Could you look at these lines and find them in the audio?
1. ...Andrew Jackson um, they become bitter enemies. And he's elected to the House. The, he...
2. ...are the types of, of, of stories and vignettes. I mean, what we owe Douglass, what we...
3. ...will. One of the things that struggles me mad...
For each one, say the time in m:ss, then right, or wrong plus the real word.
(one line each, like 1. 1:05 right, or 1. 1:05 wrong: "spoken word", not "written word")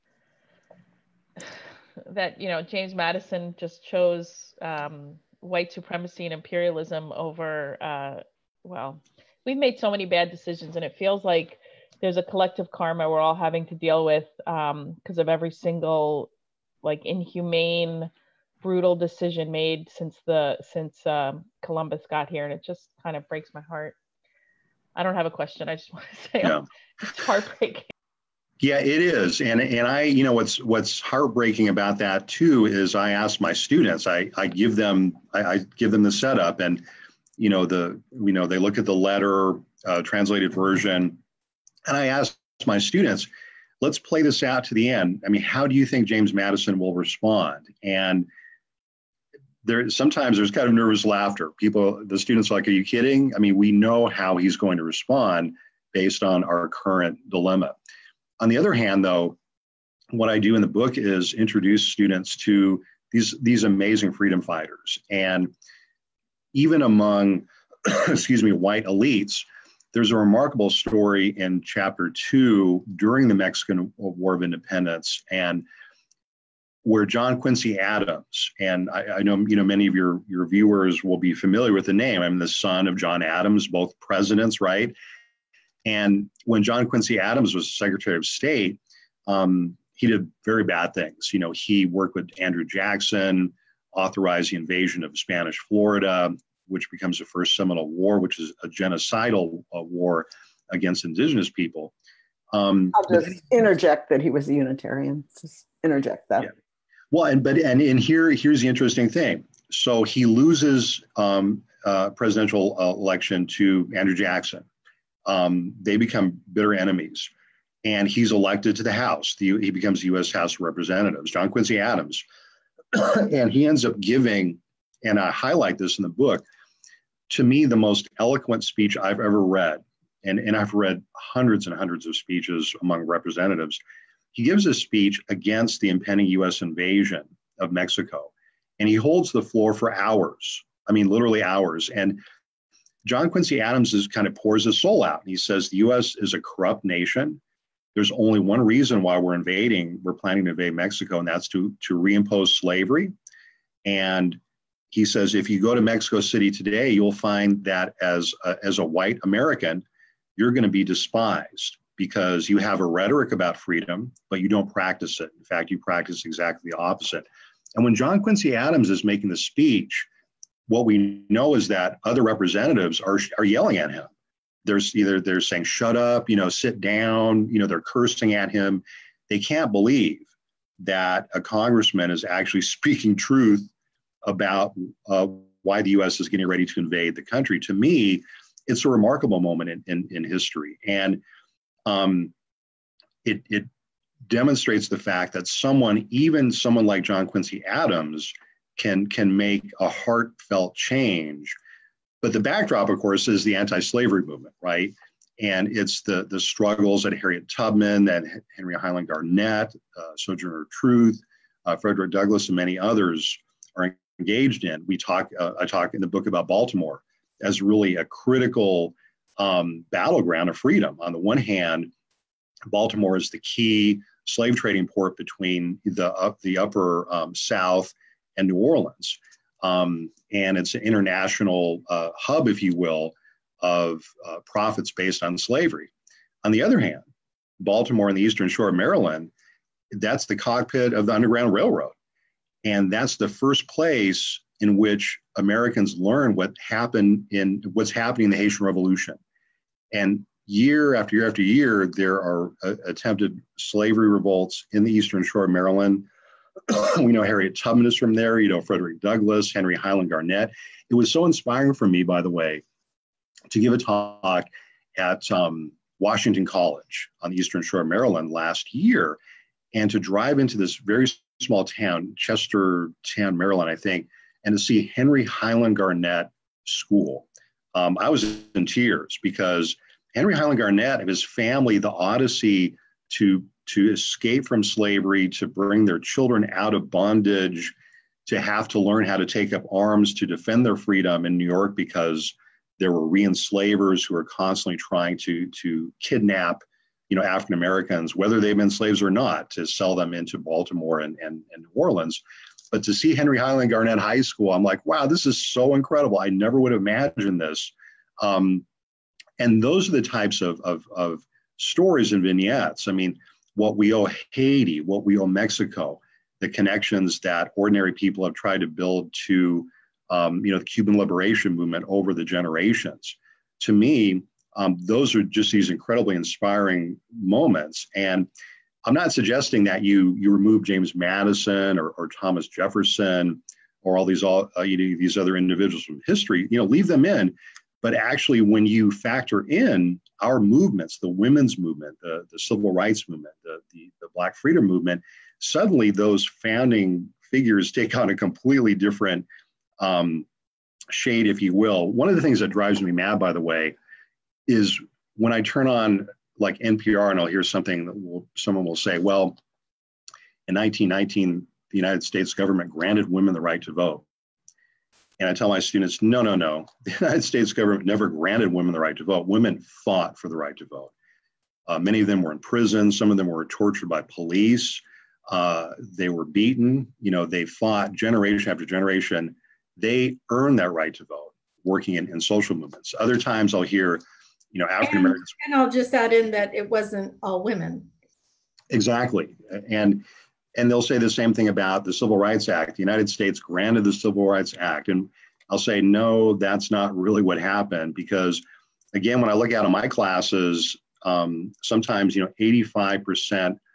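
1. 1:53 right
2. 5:09 wrong: "Haiti", not "Douglass"
3. 5:51 wrong: "drives", not "struggles".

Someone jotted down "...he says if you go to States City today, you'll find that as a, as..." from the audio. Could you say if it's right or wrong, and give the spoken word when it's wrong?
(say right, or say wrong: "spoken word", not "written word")
wrong: "Mexico", not "States".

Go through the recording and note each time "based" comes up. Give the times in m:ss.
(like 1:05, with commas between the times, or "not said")
0:55, 3:54.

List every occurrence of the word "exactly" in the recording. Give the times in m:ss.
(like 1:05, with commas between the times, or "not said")
2:46, 6:28.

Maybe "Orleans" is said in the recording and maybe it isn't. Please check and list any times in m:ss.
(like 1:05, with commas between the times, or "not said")
3:48, 5:01.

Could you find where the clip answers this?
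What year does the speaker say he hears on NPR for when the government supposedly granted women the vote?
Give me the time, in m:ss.
6:00.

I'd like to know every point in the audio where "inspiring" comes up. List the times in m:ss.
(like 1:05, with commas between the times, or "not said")
4:21, 5:26.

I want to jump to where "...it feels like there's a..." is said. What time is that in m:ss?
0:10.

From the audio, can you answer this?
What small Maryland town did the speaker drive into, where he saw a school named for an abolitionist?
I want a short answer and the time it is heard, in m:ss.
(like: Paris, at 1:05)
Chester Town, at 4:32.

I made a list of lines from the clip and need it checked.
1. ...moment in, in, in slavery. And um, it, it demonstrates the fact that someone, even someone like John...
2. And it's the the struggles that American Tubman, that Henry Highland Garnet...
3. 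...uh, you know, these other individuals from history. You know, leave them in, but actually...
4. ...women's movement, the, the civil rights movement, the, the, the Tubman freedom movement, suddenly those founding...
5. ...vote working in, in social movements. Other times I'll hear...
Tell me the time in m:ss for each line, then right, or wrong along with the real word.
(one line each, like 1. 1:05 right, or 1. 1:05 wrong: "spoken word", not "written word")
1. 3:09 wrong: "history", not "slavery"
2. 3:25 wrong: "Harriet", not "American"
3. 5:34 right
4. 5:41 wrong: "Black", not "Tubman"
5. 6:21 right.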